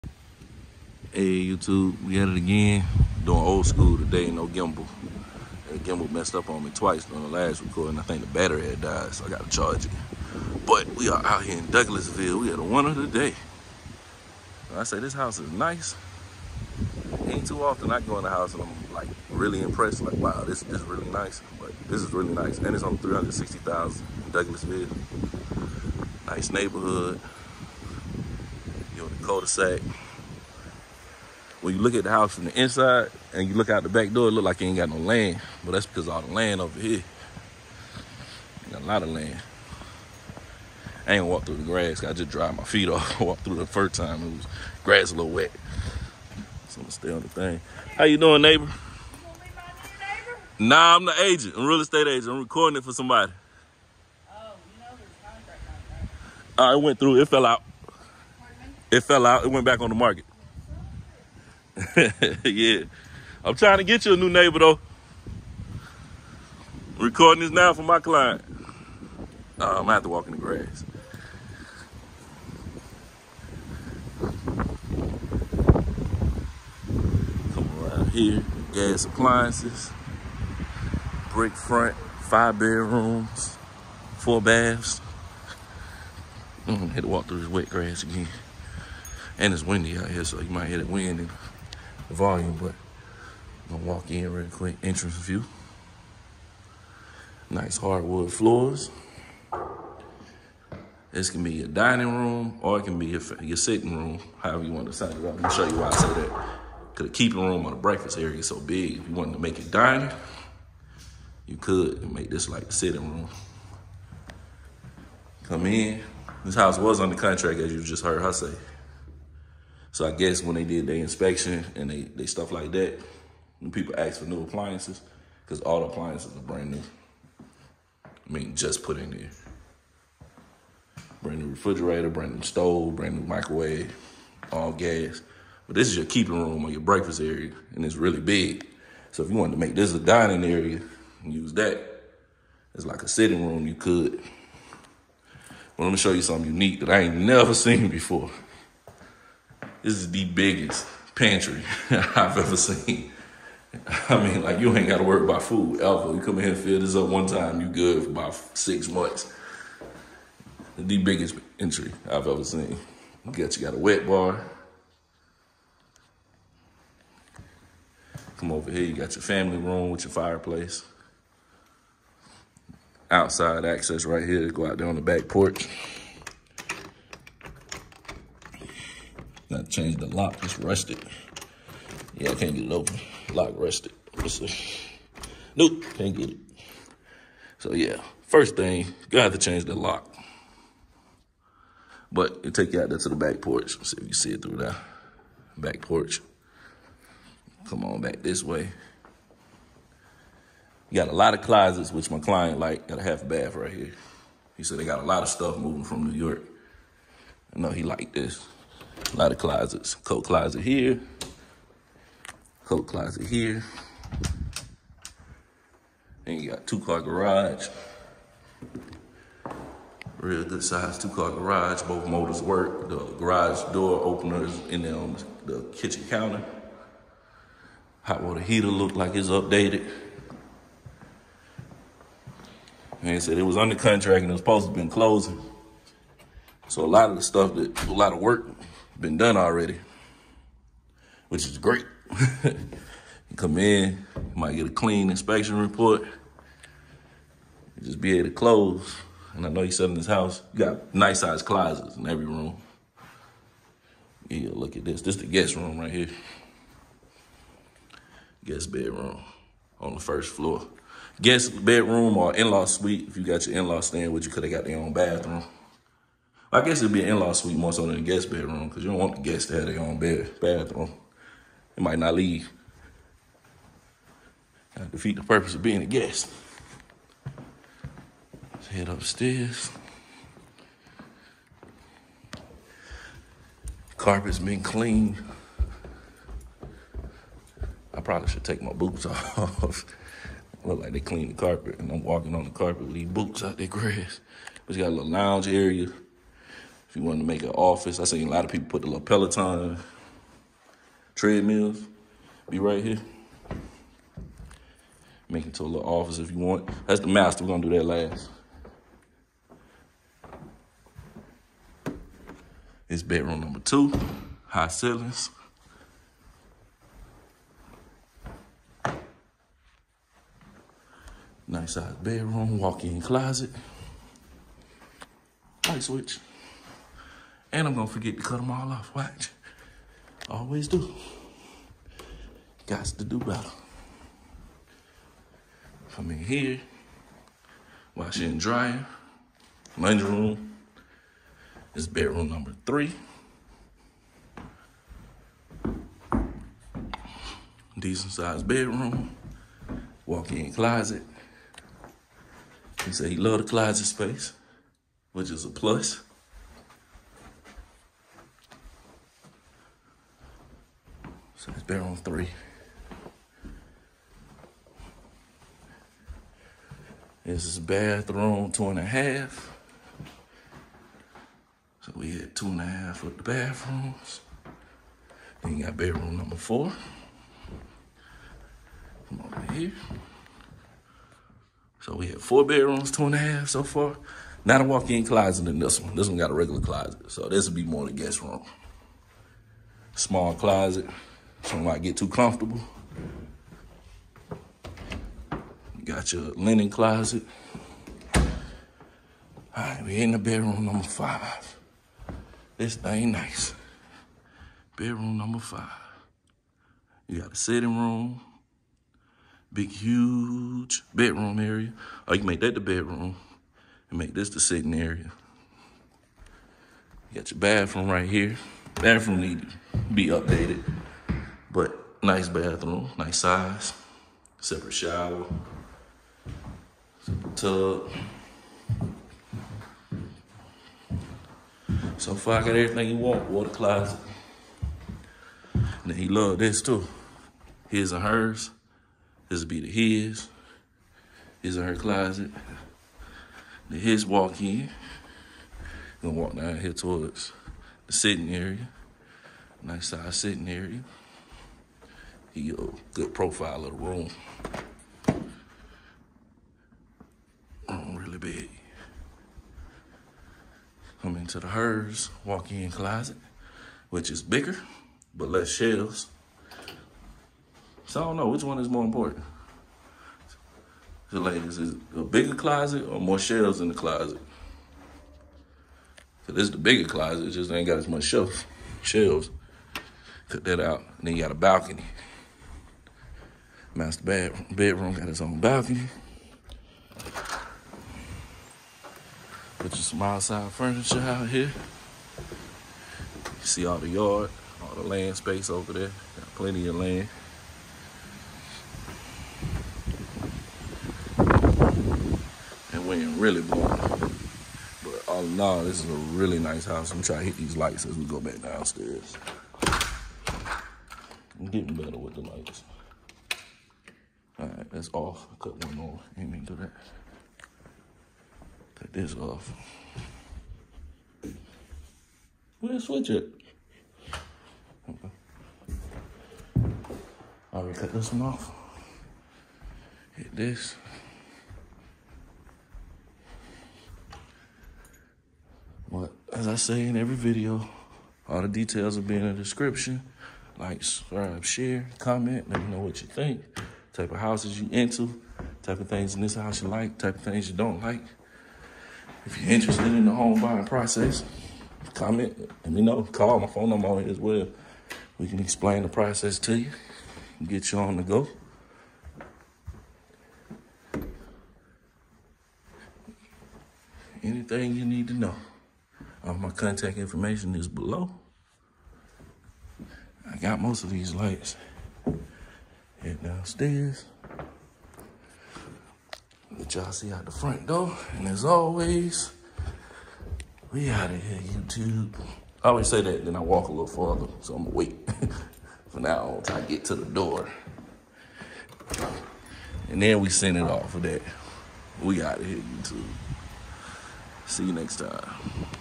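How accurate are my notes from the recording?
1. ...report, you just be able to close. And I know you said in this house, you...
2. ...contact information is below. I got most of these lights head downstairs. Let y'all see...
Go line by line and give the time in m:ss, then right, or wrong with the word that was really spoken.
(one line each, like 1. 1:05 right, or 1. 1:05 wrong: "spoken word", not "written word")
1. 4:05 right
2. 9:26 right.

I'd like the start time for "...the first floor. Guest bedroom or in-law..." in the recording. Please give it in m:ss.
4:19.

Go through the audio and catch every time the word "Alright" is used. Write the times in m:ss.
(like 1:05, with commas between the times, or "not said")
8:34, 8:47.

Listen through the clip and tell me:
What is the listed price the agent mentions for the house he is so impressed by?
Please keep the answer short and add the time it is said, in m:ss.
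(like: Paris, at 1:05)
360,000, at 0:22.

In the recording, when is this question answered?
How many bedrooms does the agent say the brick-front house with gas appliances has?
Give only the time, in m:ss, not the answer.
1:22.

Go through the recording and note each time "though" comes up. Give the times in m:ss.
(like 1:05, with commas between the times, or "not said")
1:04.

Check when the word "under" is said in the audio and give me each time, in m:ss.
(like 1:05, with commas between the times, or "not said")
1:56, 3:53.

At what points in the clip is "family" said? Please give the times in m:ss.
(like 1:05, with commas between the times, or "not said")
2:49.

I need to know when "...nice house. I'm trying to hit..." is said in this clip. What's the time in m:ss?
8:26.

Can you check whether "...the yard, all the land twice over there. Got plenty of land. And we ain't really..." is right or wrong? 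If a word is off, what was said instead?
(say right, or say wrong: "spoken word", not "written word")
wrong: "space", not "twice".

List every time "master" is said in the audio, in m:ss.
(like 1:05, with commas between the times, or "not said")
5:07, 8:03.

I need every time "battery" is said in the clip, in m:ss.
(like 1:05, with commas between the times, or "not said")
0:08.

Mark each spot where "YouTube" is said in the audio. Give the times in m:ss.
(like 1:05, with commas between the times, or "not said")
0:01, 9:41, 9:52.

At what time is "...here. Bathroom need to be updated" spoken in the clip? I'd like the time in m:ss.
6:58.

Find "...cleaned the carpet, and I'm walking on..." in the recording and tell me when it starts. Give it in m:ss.
4:50.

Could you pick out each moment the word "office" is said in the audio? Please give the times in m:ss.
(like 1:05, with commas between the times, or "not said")
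4:57, 5:05.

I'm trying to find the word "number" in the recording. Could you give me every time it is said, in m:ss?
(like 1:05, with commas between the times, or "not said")
5:13, 5:42, 6:16, 6:40, 6:45, 9:13.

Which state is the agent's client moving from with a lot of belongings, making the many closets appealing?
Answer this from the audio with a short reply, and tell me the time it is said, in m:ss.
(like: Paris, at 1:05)
New York, at 3:26.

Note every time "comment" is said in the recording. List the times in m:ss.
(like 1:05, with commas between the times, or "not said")
9:01, 9:11.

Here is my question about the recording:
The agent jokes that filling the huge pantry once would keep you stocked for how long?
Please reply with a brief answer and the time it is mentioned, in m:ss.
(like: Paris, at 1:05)
6 months, at 2:38.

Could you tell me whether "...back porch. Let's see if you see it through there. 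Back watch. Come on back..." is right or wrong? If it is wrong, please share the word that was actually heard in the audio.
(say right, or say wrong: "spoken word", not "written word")
wrong: "porch", not "watch".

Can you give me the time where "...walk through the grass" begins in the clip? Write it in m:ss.
0:41.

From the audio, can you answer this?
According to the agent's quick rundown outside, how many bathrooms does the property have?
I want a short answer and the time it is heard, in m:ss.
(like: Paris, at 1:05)
4, at 1:24.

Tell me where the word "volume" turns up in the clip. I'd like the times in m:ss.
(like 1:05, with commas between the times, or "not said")
1:32.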